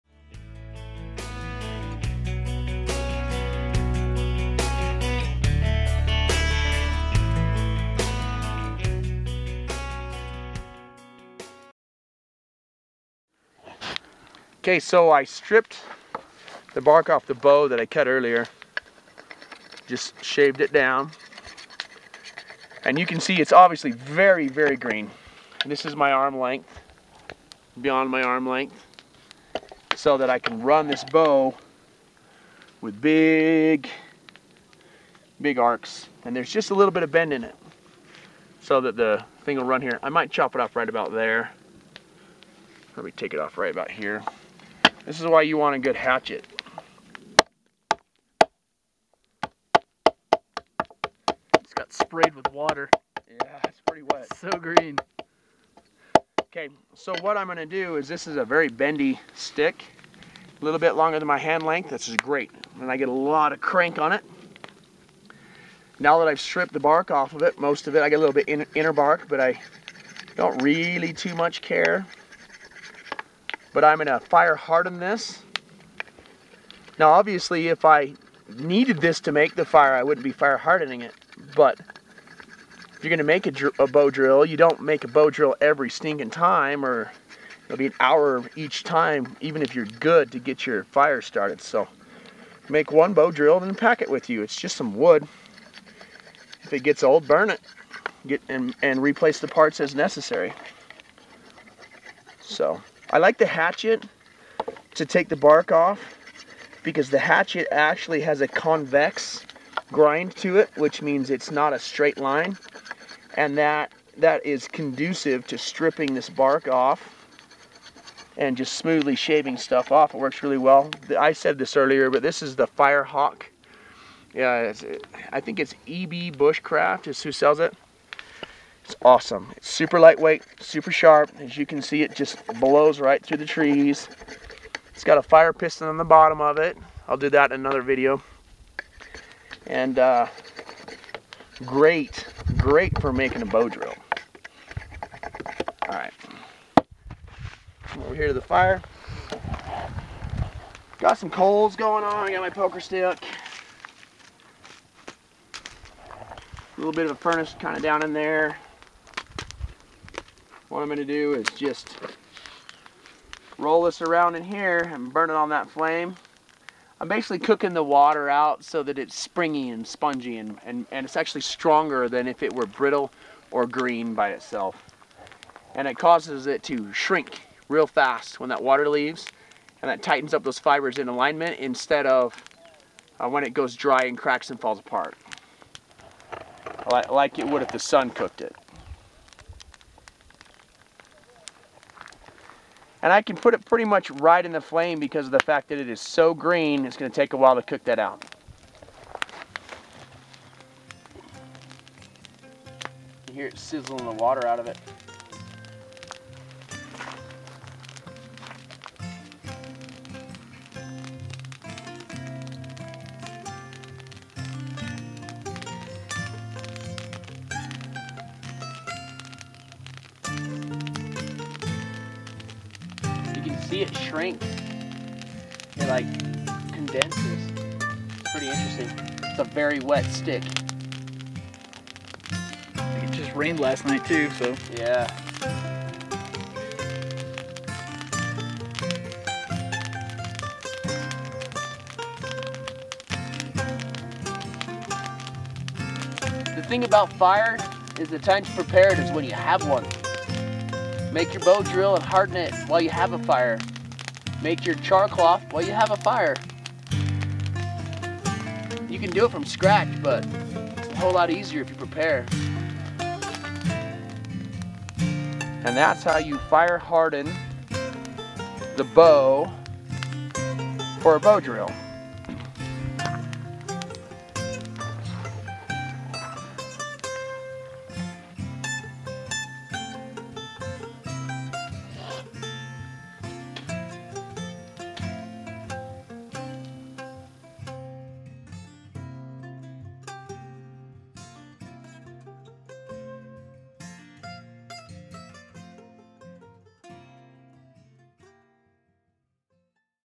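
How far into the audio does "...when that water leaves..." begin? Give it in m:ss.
2:58.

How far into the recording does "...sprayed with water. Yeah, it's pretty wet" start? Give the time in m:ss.
0:51.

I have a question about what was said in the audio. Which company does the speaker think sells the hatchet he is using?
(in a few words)
EB Bushcraft.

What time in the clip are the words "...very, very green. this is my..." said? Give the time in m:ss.
0:23.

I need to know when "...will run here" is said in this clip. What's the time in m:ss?
0:39.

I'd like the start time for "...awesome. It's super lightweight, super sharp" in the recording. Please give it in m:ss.
2:09.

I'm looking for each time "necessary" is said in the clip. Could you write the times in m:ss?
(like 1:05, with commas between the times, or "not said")
1:39.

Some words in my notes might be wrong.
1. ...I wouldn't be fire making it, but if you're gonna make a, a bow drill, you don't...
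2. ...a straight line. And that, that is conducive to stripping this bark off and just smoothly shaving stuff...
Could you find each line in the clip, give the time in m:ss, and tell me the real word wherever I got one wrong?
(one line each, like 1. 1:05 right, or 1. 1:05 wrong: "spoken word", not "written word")
1. 1:19 wrong: "hardening", not "making"
2. 1:51 right.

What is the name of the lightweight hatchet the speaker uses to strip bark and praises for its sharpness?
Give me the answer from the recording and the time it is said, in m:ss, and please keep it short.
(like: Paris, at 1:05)
Firehawk, at 2:02.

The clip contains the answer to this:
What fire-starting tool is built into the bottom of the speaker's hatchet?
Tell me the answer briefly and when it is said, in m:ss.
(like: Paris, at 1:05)
fire piston, at 2:15.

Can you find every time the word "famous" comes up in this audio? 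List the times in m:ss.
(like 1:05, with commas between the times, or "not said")
not said.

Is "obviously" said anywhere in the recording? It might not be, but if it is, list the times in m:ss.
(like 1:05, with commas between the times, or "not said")
0:23, 1:17.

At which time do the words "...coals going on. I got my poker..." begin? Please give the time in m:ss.
2:31.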